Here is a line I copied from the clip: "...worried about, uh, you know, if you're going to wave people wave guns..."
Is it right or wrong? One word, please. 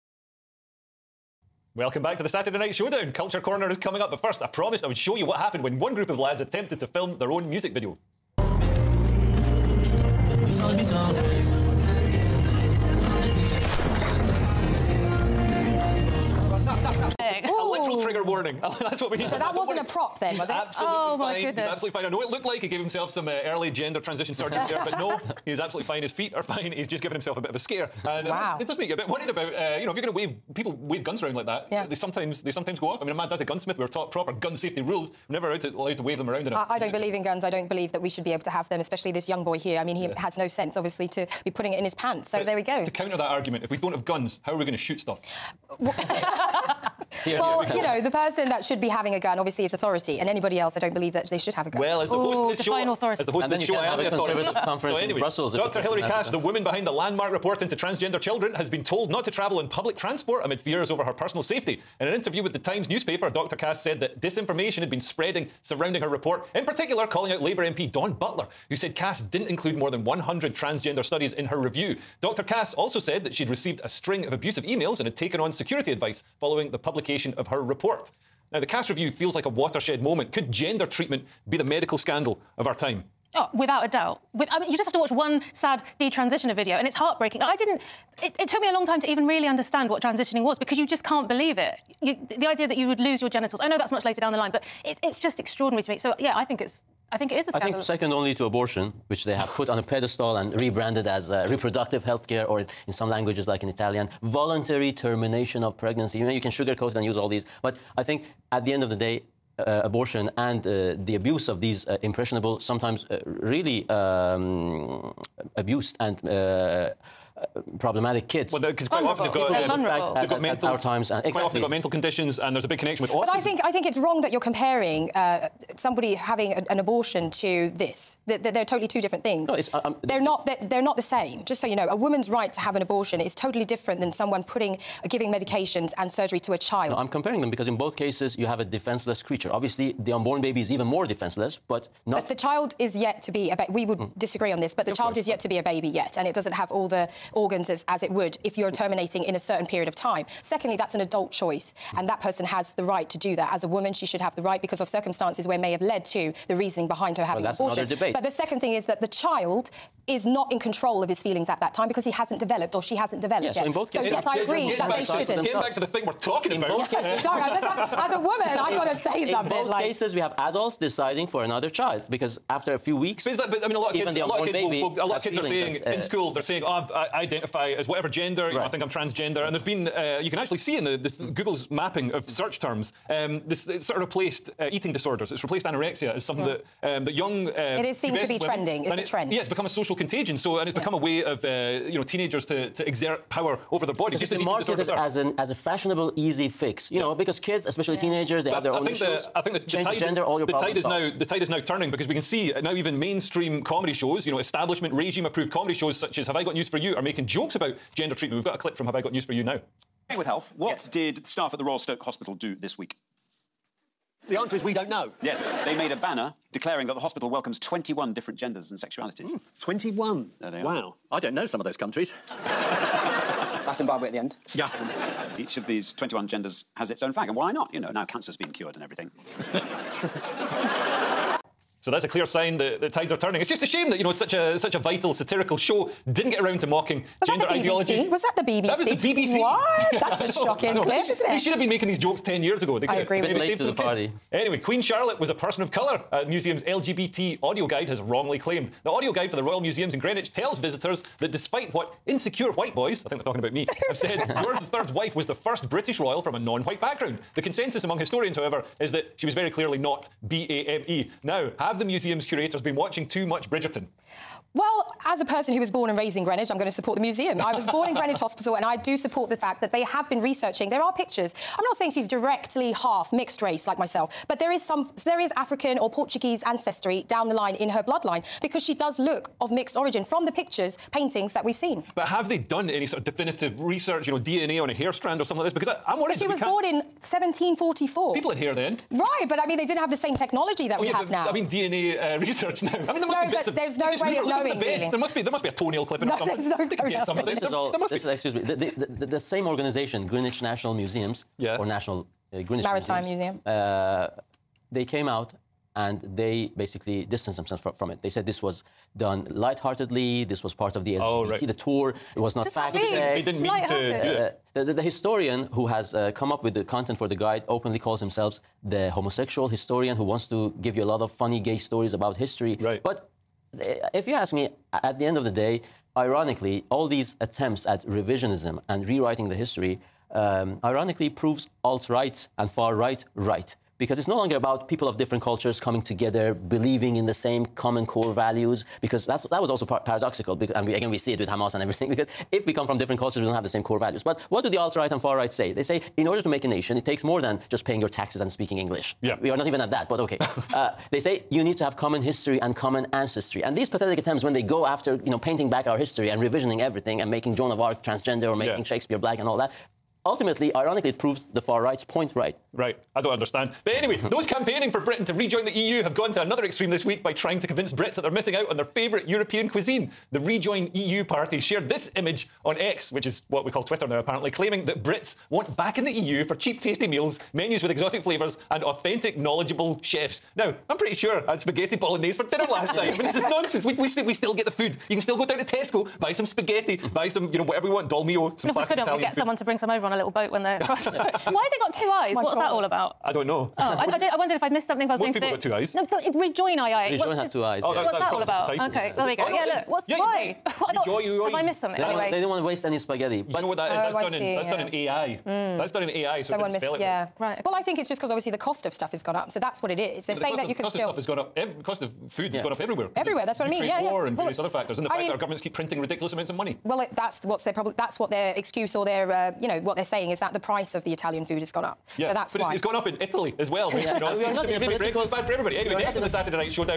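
right.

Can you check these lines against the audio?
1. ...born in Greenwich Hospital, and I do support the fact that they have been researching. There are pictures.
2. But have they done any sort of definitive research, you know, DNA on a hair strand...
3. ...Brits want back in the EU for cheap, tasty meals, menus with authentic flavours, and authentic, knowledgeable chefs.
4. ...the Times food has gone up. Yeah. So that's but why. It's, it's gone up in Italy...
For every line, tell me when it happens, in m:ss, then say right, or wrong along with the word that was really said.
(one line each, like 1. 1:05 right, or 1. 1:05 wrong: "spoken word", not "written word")
1. 4:27 right
2. 4:41 right
3. 6:14 wrong: "exotic", not "authentic"
4. 7:00 wrong: "Italian", not "Times".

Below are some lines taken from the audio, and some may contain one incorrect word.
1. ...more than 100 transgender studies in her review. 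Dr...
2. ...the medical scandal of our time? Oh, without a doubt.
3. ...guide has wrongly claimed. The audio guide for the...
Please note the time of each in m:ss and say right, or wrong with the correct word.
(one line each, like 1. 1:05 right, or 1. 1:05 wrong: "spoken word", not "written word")
1. 1:09 right
2. 1:21 right
3. 4:07 right.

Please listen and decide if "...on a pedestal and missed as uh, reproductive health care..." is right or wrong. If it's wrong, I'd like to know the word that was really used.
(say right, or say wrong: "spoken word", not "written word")
wrong: "rebranded", not "missed".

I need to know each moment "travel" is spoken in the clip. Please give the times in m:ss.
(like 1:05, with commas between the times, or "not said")
0:59.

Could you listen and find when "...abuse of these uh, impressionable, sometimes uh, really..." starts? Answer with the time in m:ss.
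1:51.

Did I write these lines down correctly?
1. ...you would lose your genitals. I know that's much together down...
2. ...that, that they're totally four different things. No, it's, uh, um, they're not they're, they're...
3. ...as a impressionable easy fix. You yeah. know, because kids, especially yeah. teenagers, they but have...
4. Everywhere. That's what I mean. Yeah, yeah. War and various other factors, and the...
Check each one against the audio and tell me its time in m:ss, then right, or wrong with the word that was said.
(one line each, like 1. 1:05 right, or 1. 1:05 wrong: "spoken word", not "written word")
1. 1:32 wrong: "later", not "together"
2. 2:08 wrong: "two", not "four"
3. 3:15 wrong: "fashionable", not "impressionable"
4. 6:52 right.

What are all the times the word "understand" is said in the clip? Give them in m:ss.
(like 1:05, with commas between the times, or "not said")
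1:29, 6:03.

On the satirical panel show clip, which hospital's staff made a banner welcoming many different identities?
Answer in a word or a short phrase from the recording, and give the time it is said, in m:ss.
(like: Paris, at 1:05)
Royal Stoke Hospital, at 3:31.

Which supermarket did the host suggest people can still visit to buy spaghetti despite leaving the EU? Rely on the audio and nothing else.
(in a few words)
Tesco.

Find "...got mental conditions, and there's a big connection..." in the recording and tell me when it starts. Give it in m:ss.
2:01.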